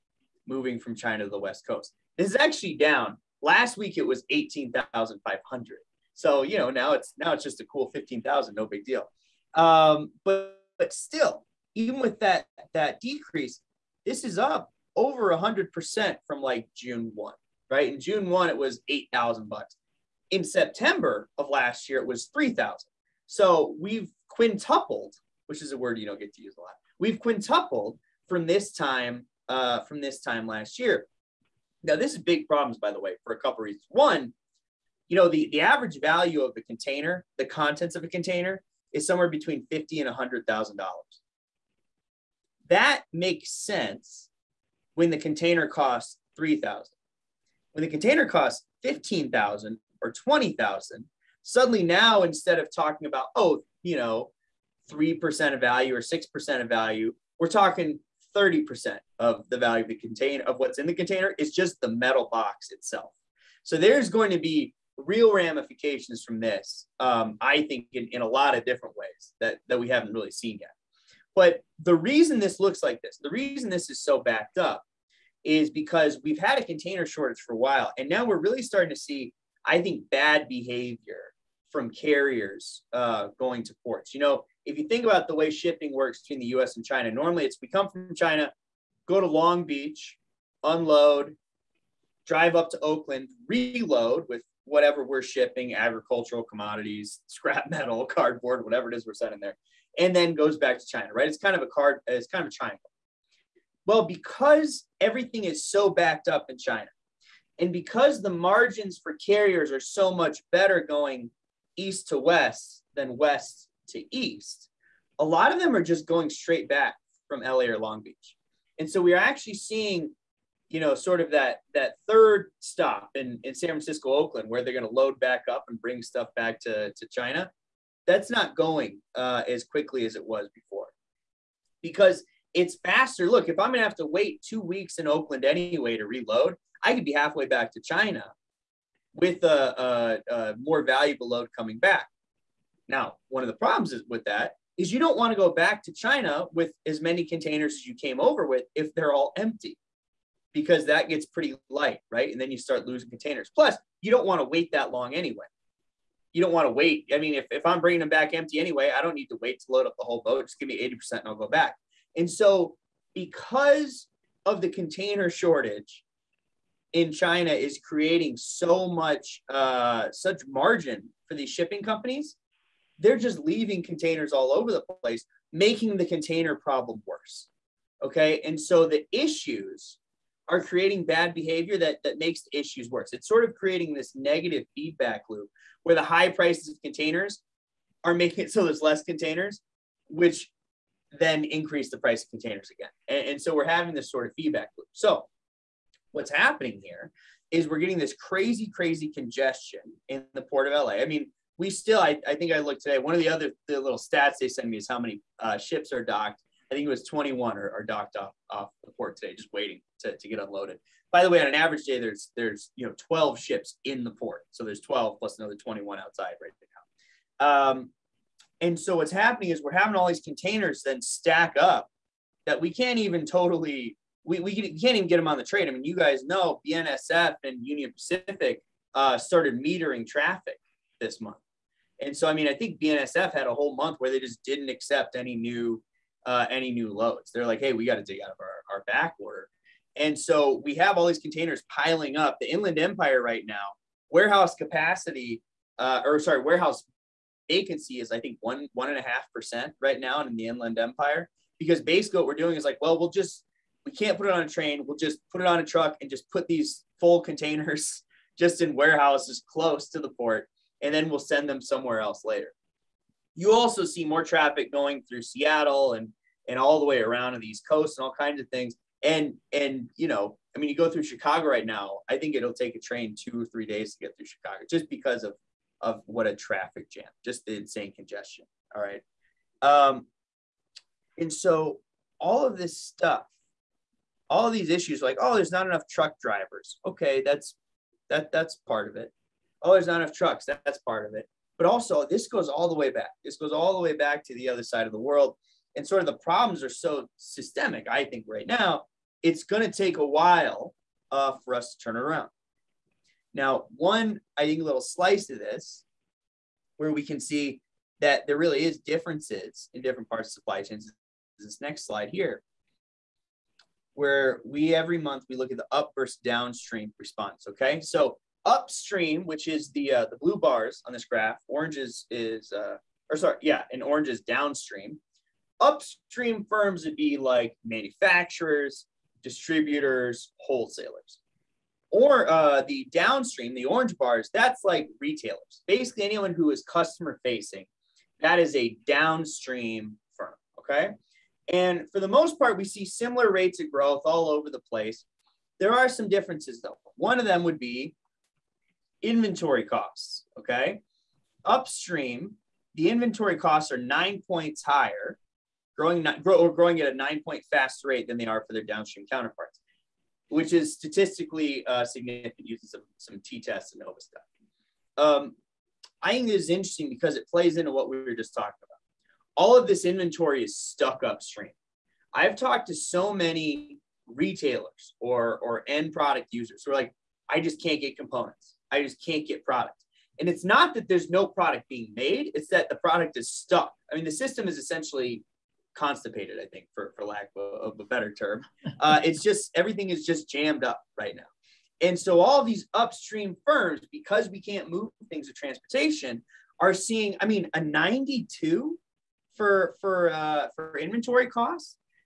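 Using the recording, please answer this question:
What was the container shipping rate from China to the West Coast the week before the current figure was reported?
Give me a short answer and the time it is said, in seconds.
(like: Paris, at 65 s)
18,500, at 4 s.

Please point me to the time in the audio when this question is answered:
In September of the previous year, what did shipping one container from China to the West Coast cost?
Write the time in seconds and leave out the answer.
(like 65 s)
22 s.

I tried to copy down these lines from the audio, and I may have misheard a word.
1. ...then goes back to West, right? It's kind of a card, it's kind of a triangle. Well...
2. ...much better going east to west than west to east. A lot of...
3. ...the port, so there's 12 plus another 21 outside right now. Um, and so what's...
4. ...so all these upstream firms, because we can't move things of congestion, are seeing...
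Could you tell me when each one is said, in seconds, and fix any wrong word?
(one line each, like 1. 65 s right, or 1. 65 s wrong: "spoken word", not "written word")
1. 100 s wrong: "China", not "West"
2. 110 s right
3. 214 s right
4. 391 s wrong: "transportation", not "congestion".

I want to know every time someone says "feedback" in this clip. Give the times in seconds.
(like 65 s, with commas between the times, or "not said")
184 s, 194 s.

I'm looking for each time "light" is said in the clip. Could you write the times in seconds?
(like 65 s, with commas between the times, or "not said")
151 s.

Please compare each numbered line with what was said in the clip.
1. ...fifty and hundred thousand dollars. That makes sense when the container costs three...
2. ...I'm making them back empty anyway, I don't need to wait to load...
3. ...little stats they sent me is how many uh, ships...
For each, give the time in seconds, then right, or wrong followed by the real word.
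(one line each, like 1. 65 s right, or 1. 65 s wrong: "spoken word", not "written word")
1. 39 s right
2. 157 s wrong: "bringing", not "making"
3. 203 s right.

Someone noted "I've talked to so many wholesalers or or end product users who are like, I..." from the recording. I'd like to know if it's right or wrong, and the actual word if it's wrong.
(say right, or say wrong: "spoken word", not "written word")
wrong: "retailers", not "wholesalers".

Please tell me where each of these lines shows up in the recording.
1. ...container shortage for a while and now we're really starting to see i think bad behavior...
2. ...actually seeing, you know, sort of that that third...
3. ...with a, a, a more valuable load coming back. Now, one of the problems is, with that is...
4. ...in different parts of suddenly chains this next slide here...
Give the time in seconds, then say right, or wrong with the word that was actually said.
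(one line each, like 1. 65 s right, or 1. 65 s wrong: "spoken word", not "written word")
1. 76 s right
2. 119 s right
3. 139 s right
4. 309 s wrong: "supply", not "suddenly".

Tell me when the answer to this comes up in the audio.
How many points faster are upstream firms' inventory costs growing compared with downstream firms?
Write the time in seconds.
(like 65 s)
353 s.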